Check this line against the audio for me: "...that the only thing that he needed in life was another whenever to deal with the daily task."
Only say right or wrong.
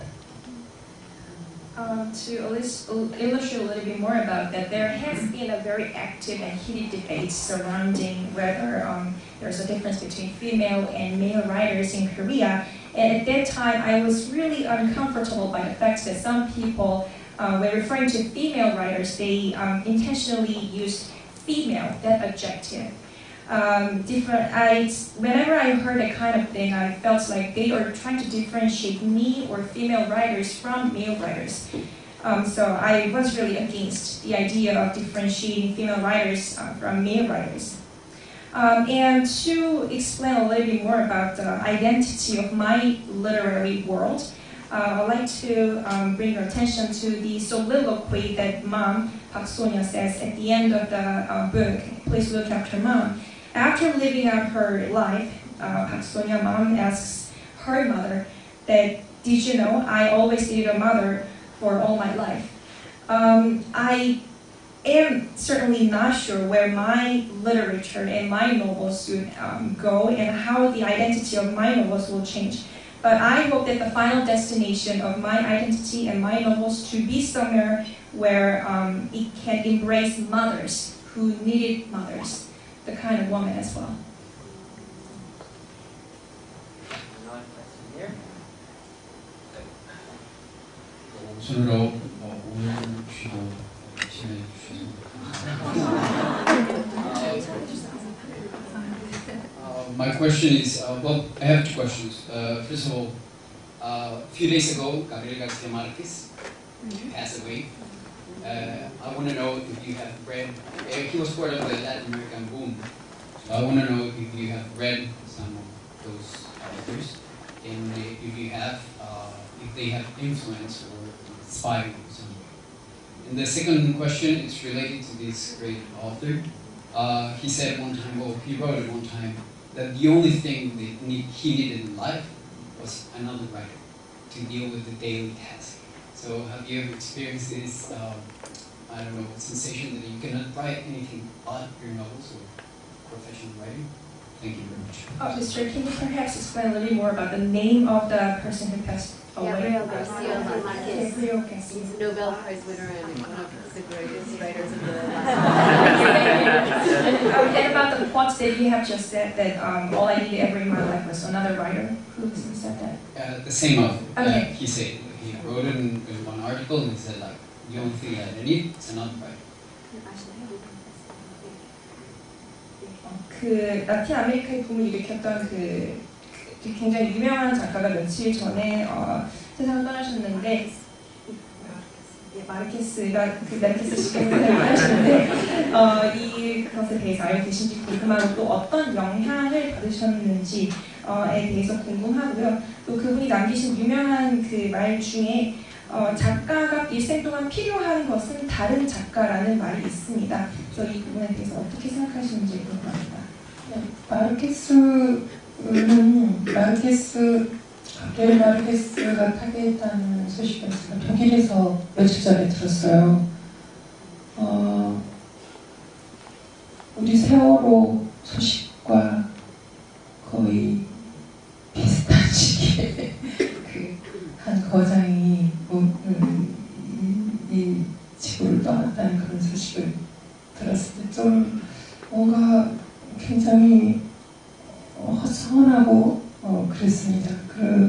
wrong.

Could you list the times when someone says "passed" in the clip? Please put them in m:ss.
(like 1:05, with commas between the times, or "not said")
1:47, 2:28.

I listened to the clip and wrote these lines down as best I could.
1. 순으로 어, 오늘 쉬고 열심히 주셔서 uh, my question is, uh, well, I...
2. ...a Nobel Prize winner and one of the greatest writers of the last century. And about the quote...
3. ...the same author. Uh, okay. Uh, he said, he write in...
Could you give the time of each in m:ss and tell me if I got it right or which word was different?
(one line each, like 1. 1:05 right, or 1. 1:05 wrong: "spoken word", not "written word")
1. 1:31 right
2. 2:31 right
3. 2:43 wrong: "wrote", not "write".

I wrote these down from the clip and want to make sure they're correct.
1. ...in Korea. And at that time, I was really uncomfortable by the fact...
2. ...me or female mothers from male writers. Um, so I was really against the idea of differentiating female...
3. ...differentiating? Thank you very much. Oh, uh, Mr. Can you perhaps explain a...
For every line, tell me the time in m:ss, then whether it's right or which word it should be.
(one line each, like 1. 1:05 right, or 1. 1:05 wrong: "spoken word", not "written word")
1. 0:11 right
2. 0:29 wrong: "writers", not "mothers"
3. 2:23 wrong: "writing", not "differentiating".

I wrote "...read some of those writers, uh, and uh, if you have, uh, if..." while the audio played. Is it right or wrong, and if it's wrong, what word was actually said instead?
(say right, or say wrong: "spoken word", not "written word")
wrong: "authors", not "writers".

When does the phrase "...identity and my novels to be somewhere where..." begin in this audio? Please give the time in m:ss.
1:15.